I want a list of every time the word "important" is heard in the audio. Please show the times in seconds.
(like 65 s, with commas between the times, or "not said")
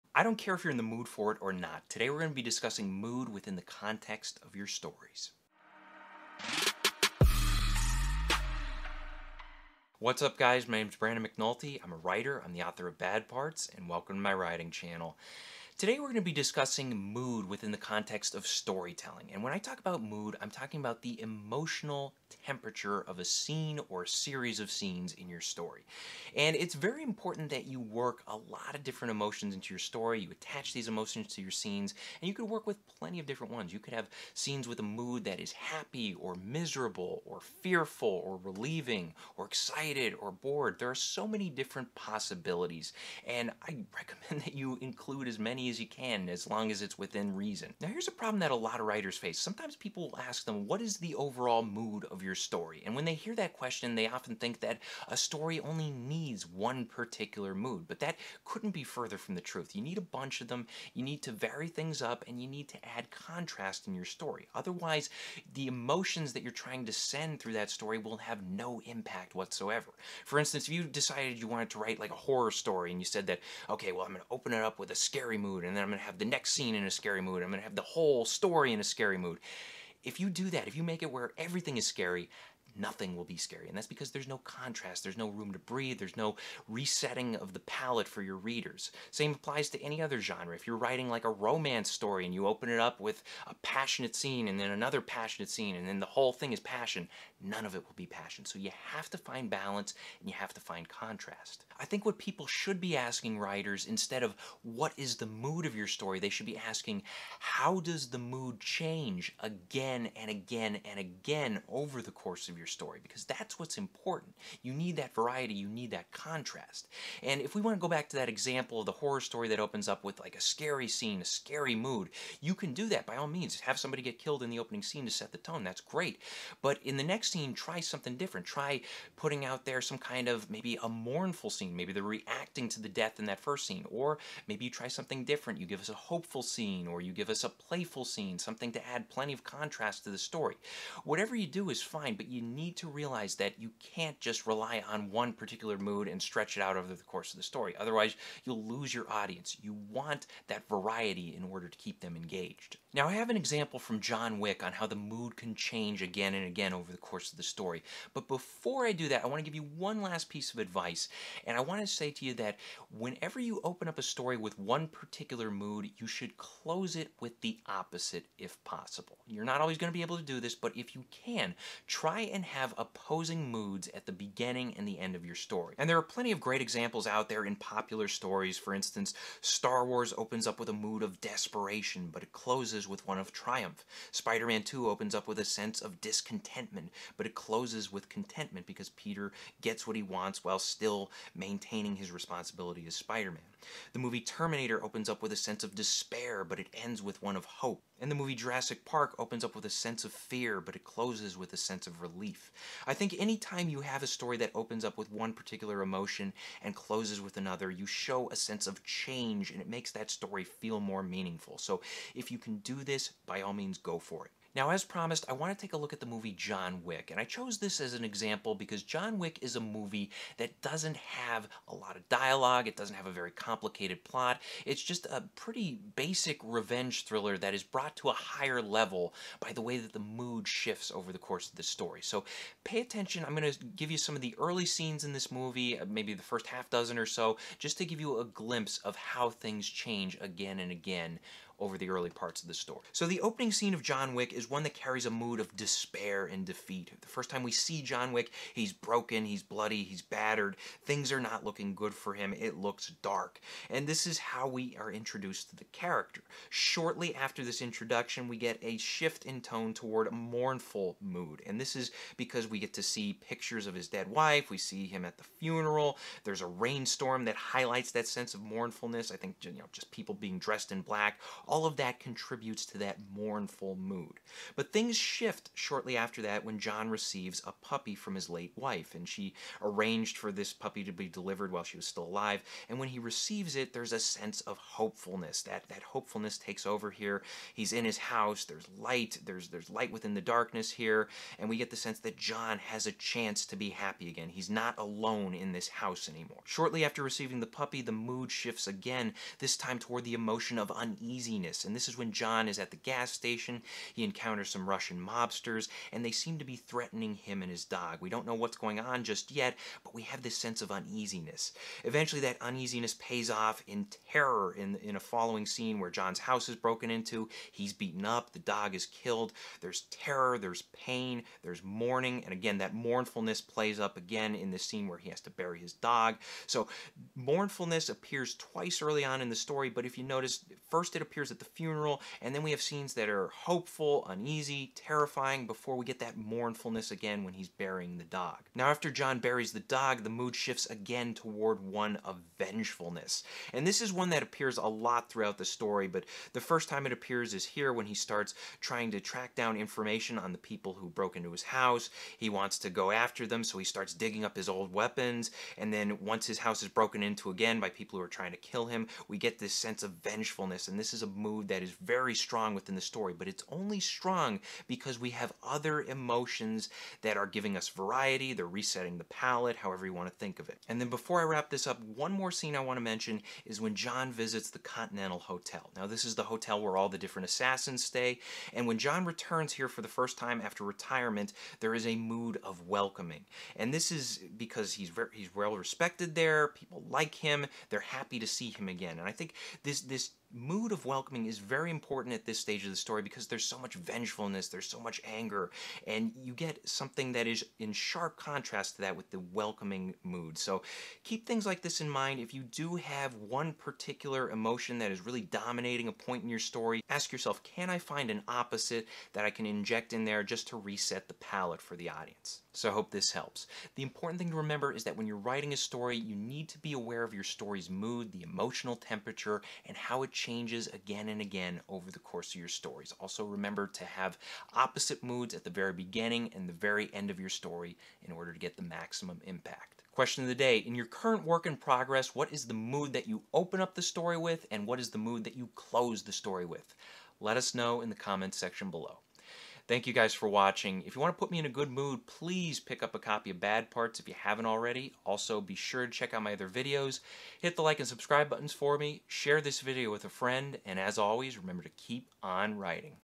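27 s, 113 s, 391 s, 413 s.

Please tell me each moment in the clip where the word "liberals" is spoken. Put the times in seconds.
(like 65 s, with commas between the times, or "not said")
not said.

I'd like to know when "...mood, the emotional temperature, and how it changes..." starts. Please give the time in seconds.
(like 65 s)
417 s.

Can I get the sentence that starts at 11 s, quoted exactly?
I'm a writer, I'm the author of Bad Parts, and welcome to my writing channel.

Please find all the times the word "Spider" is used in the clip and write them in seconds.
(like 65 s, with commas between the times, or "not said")
184 s, 192 s.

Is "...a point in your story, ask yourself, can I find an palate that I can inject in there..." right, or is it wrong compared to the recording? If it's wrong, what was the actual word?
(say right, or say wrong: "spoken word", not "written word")
wrong: "opposite", not "palate".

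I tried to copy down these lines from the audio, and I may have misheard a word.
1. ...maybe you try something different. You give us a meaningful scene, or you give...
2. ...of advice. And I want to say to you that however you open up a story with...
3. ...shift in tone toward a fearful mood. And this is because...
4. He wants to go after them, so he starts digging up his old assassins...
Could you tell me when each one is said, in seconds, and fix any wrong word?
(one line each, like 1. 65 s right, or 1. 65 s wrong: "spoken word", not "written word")
1. 134 s wrong: "hopeful", not "meaningful"
2. 160 s wrong: "whenever", not "however"
3. 258 s wrong: "mournful", not "fearful"
4. 352 s wrong: "weapons", not "assassins".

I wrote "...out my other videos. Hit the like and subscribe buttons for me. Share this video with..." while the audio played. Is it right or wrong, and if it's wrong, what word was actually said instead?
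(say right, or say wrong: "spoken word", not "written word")
right.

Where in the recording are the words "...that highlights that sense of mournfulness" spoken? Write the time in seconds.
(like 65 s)
267 s.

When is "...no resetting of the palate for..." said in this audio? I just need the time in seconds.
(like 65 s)
86 s.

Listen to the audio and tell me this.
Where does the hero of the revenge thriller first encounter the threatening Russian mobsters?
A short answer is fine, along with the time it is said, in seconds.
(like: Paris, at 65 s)
The gas station, at 302 s.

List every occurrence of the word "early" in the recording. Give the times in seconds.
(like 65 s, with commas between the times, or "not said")
234 s, 241 s, 328 s.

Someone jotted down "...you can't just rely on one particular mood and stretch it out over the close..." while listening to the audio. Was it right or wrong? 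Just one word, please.
wrong.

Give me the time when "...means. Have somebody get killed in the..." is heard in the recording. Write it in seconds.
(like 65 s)
123 s.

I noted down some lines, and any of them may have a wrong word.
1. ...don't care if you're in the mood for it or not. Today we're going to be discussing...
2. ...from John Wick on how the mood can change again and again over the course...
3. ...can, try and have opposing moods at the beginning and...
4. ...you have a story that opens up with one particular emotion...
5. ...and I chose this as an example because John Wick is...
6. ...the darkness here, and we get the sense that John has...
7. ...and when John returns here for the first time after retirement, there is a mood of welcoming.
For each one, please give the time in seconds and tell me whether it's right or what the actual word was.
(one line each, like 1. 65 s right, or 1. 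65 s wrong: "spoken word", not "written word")
1. 0 s right
2. 153 s right
3. 171 s right
4. 203 s right
5. 217 s right
6. 290 s right
7. 378 s right.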